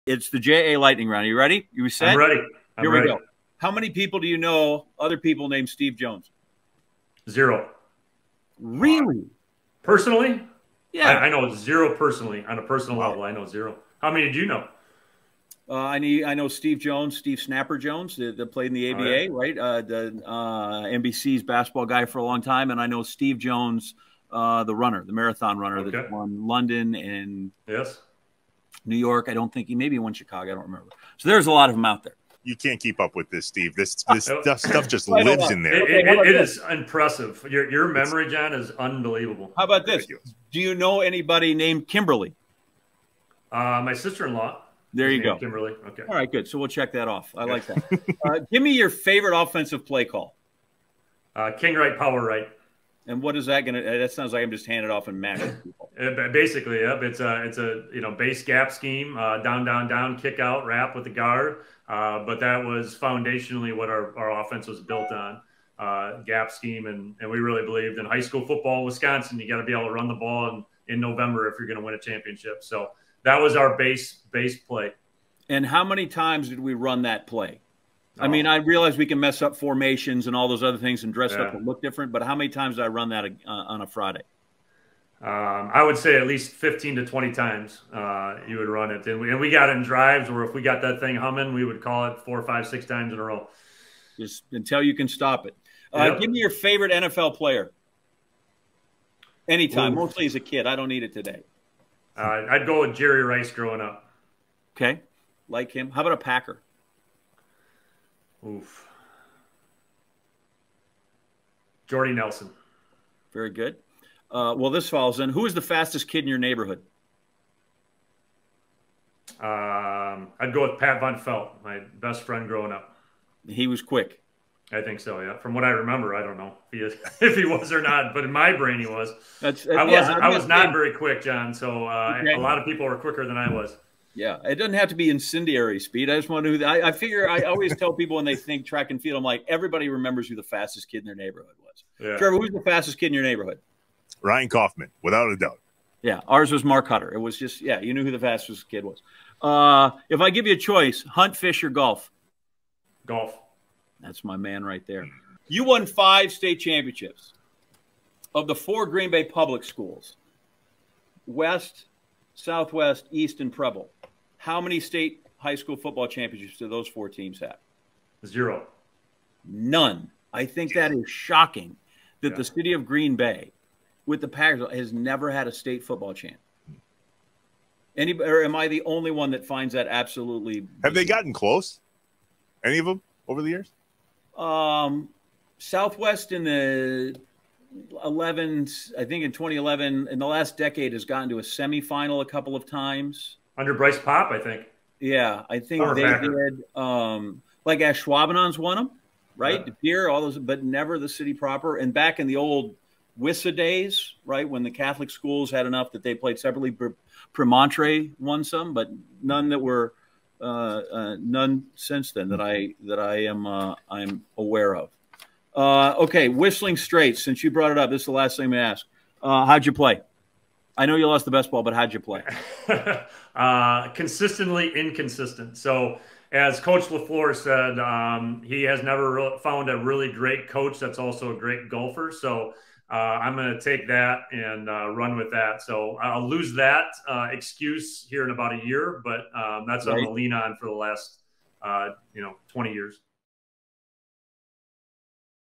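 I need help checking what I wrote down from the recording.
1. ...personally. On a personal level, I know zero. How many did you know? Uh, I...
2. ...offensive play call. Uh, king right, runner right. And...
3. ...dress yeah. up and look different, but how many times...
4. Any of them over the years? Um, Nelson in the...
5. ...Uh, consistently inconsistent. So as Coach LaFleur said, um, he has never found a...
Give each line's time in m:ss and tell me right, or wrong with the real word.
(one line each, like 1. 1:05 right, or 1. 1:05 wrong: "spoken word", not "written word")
1. 0:11 right
2. 0:49 wrong: "power", not "runner"
3. 1:21 right
4. 3:02 wrong: "Southwest", not "Nelson"
5. 3:43 right.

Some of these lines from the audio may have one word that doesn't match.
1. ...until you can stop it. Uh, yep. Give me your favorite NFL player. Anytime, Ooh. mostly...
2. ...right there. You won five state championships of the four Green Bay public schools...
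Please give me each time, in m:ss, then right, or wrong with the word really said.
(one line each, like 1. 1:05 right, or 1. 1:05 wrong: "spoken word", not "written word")
1. 1:34 right
2. 2:34 right.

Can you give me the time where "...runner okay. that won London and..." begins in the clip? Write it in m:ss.
0:25.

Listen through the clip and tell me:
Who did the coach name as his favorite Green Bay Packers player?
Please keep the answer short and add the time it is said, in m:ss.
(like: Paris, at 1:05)
Jordy Nelson, at 1:51.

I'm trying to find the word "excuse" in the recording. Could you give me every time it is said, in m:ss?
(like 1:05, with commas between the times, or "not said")
3:57.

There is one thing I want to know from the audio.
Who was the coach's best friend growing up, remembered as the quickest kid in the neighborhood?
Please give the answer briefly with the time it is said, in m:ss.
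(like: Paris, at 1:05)
Pat Von Felt, at 2:00.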